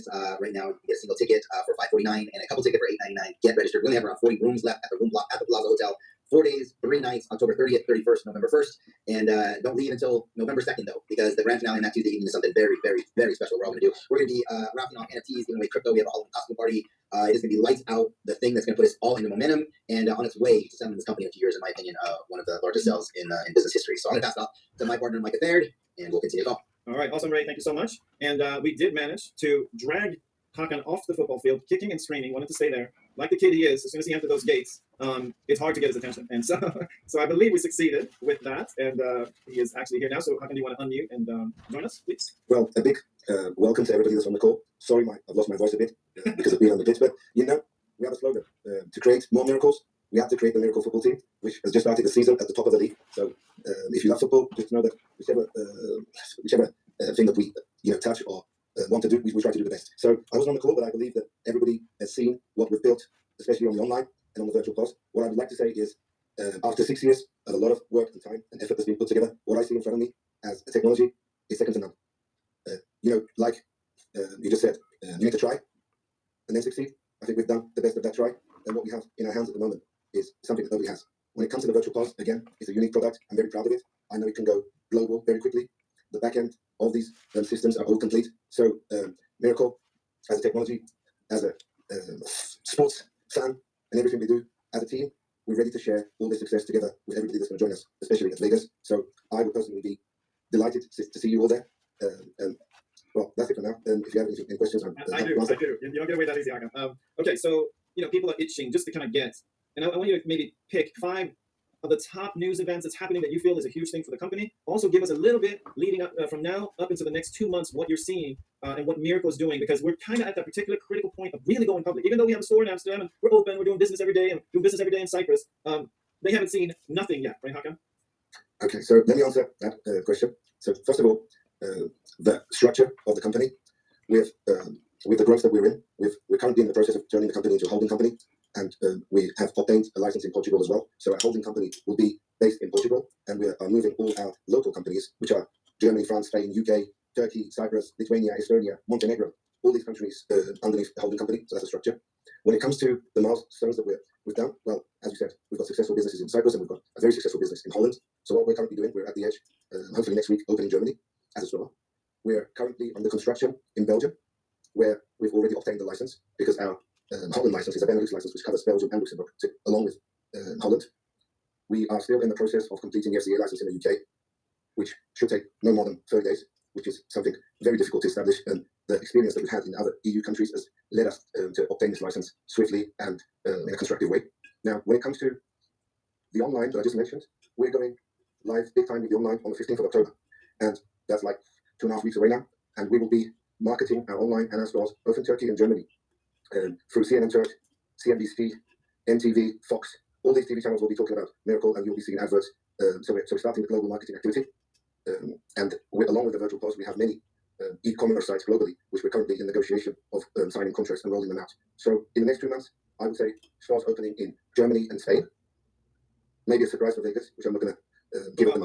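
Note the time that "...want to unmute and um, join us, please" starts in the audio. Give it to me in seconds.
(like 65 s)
40 s.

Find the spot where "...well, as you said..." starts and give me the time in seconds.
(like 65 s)
154 s.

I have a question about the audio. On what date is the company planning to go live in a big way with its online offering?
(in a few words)
October 15.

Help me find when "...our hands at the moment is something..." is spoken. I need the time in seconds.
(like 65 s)
79 s.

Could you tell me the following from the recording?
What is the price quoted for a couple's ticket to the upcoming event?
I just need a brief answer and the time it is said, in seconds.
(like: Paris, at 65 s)
899, at 3 s.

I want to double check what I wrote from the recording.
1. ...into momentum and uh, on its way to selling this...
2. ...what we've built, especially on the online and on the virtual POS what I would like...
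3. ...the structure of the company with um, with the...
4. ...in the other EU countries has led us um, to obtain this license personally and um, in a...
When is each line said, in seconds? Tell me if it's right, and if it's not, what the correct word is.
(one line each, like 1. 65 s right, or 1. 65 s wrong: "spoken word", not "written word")
1. 19 s right
2. 62 s right
3. 132 s right
4. 179 s wrong: "swiftly", not "personally".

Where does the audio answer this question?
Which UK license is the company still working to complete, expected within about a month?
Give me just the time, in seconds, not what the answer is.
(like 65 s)
173 s.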